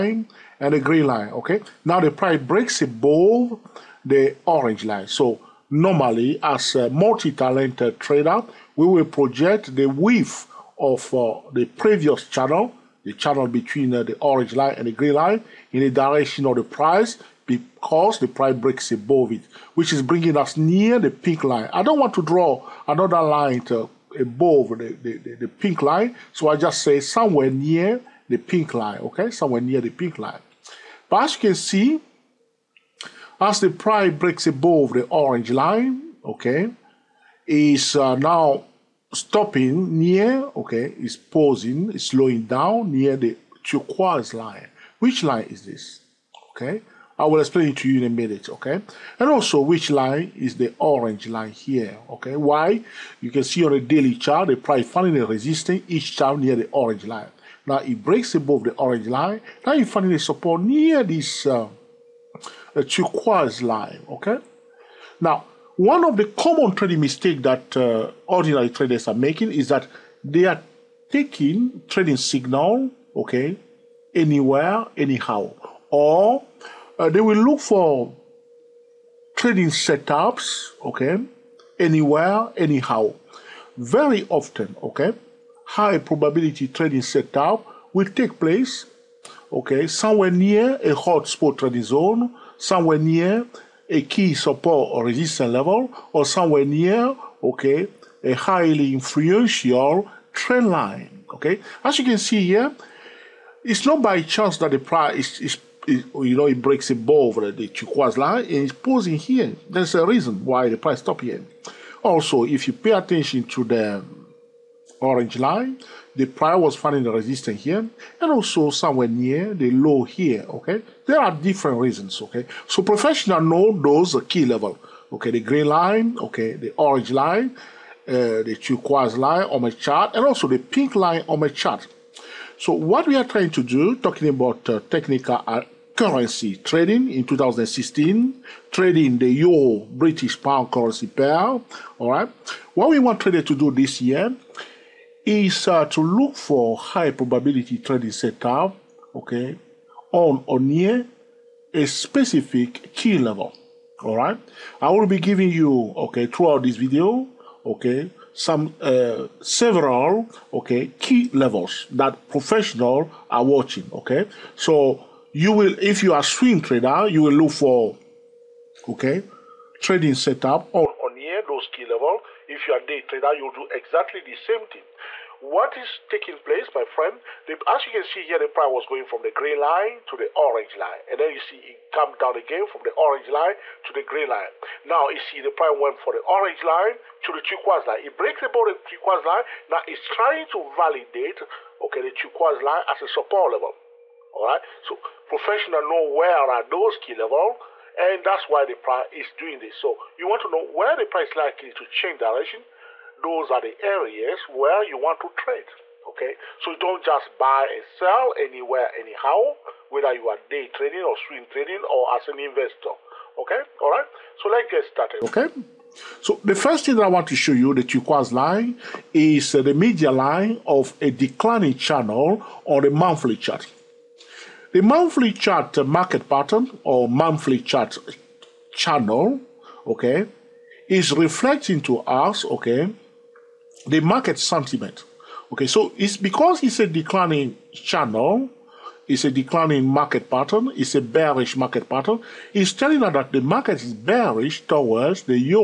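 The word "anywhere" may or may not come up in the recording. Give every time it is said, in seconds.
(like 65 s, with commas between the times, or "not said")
74 s, 81 s, 208 s.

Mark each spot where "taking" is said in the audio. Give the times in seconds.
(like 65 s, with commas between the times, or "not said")
71 s, 175 s.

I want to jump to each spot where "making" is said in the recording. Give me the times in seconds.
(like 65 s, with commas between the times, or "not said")
69 s.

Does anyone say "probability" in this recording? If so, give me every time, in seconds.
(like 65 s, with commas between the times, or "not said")
85 s, 147 s.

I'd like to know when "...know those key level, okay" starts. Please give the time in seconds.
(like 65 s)
123 s.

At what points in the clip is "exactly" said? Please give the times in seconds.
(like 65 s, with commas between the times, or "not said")
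173 s.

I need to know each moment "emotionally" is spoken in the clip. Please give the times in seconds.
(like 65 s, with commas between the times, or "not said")
not said.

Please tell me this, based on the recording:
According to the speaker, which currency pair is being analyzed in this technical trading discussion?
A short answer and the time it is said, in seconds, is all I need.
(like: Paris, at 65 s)
euro British pound, at 139 s.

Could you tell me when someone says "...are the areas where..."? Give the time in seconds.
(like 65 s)
203 s.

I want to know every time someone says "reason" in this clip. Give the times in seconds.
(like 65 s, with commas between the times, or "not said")
110 s, 121 s.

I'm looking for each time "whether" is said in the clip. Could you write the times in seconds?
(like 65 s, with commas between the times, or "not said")
209 s.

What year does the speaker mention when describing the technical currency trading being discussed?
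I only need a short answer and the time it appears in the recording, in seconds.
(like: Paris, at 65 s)
2016, at 137 s.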